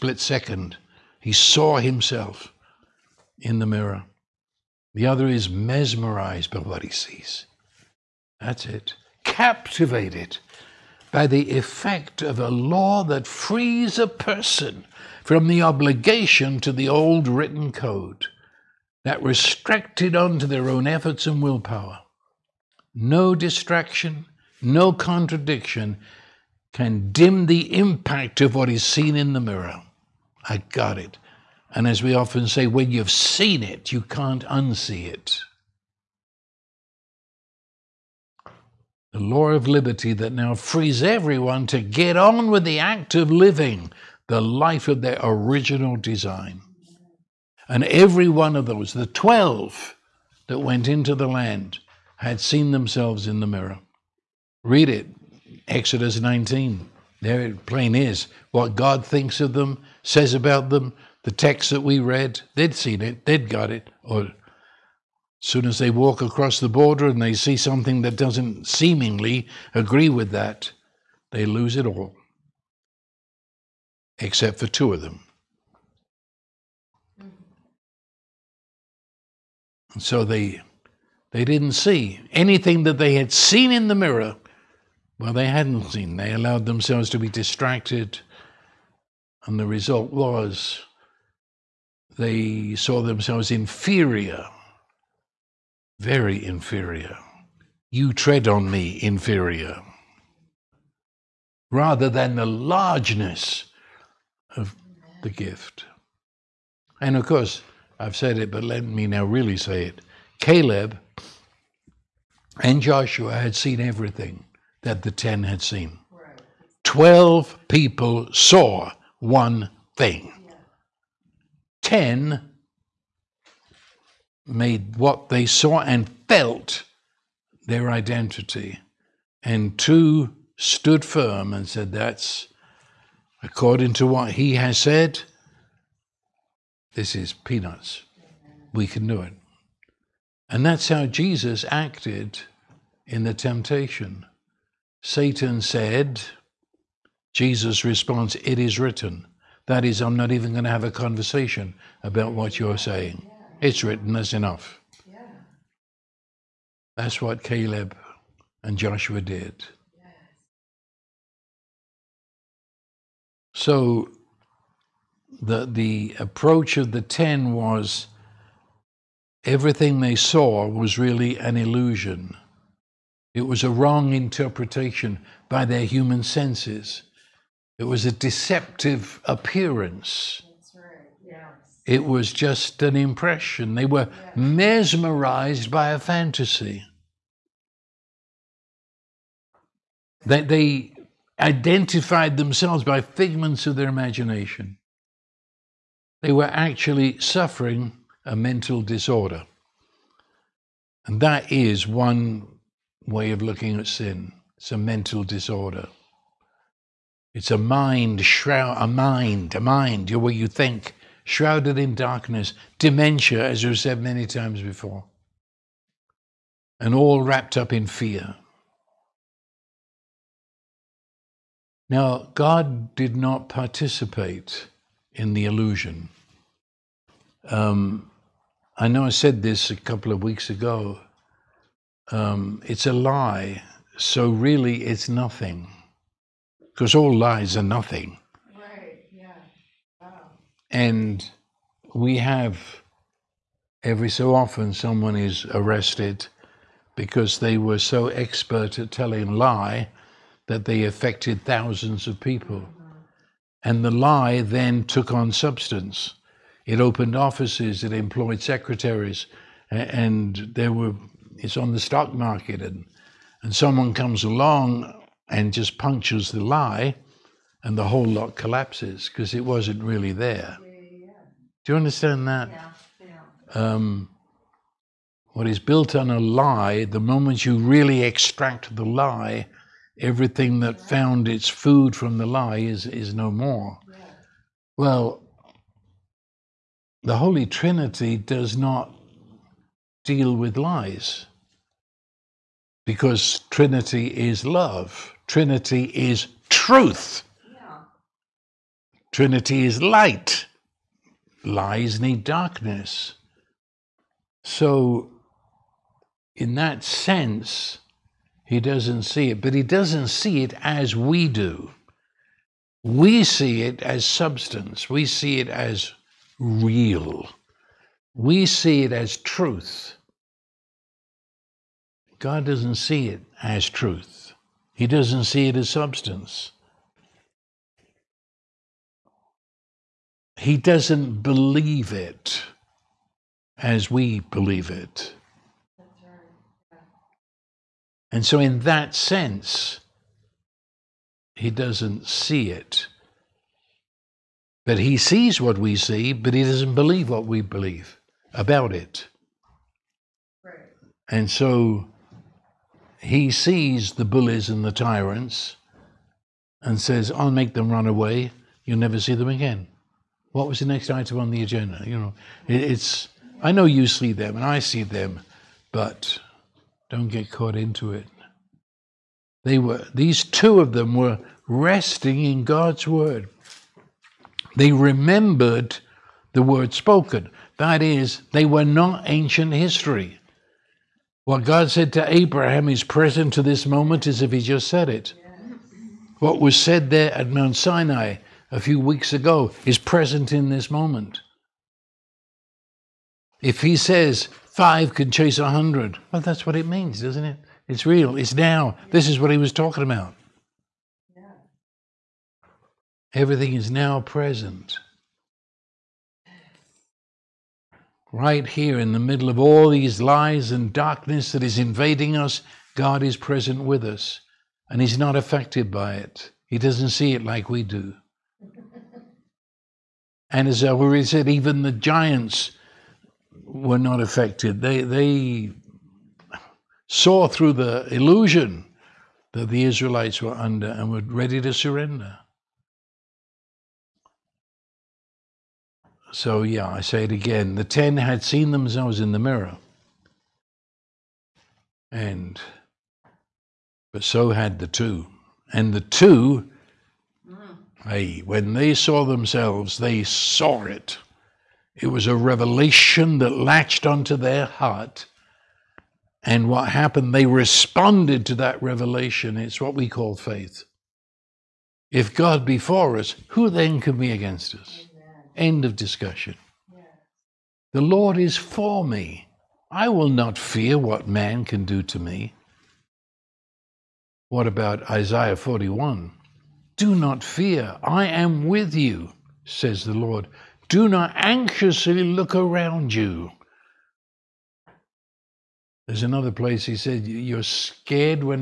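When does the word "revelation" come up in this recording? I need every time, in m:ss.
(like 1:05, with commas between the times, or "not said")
7:32, 7:38.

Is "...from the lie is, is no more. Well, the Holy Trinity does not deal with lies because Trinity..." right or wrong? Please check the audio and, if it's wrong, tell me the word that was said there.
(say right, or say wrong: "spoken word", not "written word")
right.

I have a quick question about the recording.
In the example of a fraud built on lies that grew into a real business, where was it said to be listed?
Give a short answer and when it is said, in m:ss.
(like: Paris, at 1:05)
stock market, at 4:21.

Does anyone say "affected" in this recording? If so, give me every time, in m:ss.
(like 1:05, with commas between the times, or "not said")
4:10, 6:55, 7:04.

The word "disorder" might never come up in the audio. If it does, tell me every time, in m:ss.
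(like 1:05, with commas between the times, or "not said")
3:18, 3:25.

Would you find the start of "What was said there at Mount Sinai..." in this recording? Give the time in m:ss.
6:26.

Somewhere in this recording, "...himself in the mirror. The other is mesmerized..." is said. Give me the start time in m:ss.
0:01.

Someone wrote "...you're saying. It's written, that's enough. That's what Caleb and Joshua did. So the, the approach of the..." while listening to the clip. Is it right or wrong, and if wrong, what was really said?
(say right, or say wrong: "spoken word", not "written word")
right.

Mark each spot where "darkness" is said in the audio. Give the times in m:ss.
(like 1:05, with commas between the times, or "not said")
3:31, 5:02, 6:50.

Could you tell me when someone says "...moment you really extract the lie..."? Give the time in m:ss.
4:37.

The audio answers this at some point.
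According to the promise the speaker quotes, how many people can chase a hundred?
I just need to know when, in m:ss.
6:34.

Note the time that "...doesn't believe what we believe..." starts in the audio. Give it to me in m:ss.
5:46.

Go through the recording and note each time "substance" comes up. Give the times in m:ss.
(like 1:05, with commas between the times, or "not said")
4:15, 5:14, 5:25.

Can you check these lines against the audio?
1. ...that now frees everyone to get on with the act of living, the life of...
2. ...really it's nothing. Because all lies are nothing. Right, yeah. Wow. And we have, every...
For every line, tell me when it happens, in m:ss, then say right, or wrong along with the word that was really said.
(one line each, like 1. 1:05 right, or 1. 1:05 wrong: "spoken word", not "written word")
1. 0:40 right
2. 3:54 right.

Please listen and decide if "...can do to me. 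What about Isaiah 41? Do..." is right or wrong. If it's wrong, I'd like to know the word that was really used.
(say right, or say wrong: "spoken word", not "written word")
right.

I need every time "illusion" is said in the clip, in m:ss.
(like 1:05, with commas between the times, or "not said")
2:51, 3:45, 7:07.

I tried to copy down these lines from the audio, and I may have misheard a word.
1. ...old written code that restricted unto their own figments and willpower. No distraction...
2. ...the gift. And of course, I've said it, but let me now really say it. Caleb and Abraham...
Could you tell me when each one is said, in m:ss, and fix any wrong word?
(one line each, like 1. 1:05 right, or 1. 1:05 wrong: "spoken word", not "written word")
1. 0:16 wrong: "efforts", not "figments"
2. 1:45 wrong: "Joshua", not "Abraham".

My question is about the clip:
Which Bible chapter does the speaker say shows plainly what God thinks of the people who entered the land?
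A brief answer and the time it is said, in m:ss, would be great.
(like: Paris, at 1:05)
Exodus 19, at 0:55.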